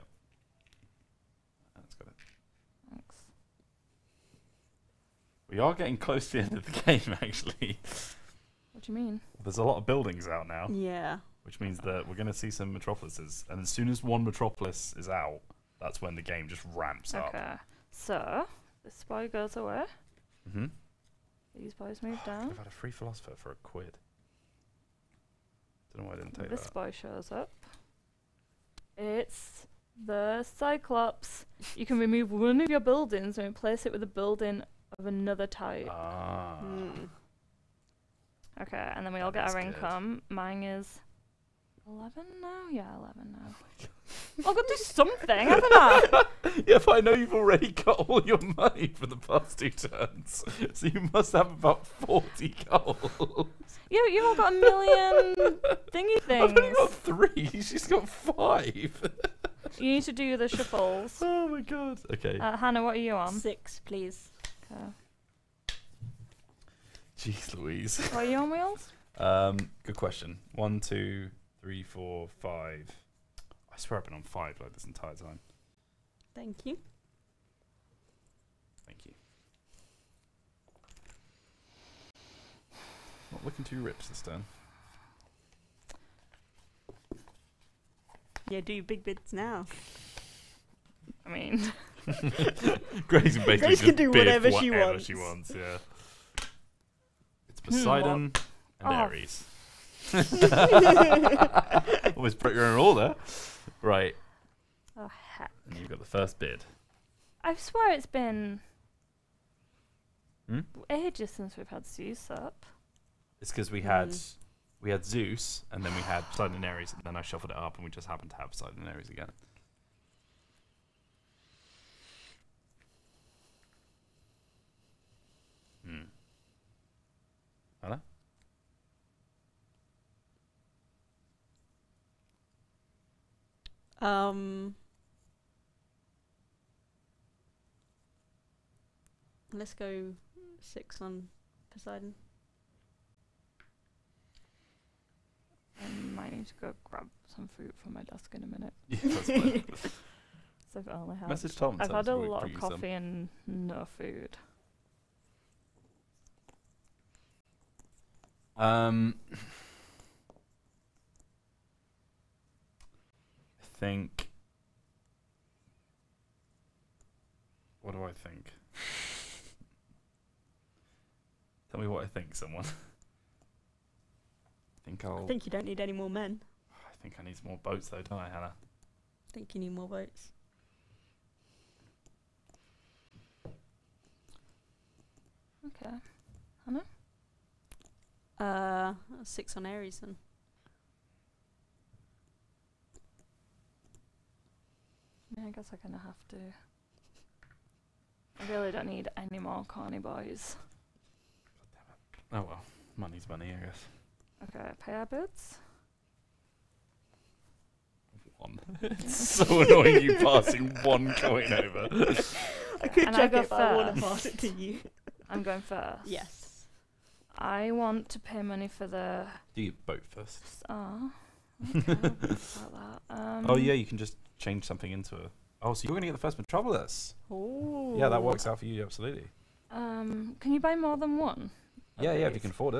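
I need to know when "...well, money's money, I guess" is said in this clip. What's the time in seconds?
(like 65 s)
202 s.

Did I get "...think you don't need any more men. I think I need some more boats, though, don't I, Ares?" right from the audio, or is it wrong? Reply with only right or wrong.
wrong.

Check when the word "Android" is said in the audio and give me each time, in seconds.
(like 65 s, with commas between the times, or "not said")
not said.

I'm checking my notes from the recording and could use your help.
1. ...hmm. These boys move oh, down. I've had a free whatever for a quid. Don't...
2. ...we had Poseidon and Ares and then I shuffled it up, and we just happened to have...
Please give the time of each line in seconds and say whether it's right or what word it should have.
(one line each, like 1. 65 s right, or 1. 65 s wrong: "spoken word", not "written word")
1. 20 s wrong: "philosopher", not "whatever"
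2. 115 s right.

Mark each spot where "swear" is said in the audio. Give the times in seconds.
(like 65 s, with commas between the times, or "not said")
73 s, 107 s.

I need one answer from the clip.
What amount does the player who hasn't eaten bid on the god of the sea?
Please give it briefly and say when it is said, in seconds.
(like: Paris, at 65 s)
6, at 140 s.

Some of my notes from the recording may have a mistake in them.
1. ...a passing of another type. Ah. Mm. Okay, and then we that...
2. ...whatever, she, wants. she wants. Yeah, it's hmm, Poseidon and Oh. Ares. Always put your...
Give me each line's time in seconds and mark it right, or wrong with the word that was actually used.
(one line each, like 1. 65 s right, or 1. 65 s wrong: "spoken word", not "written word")
1. 34 s wrong: "building", not "passing"
2. 94 s right.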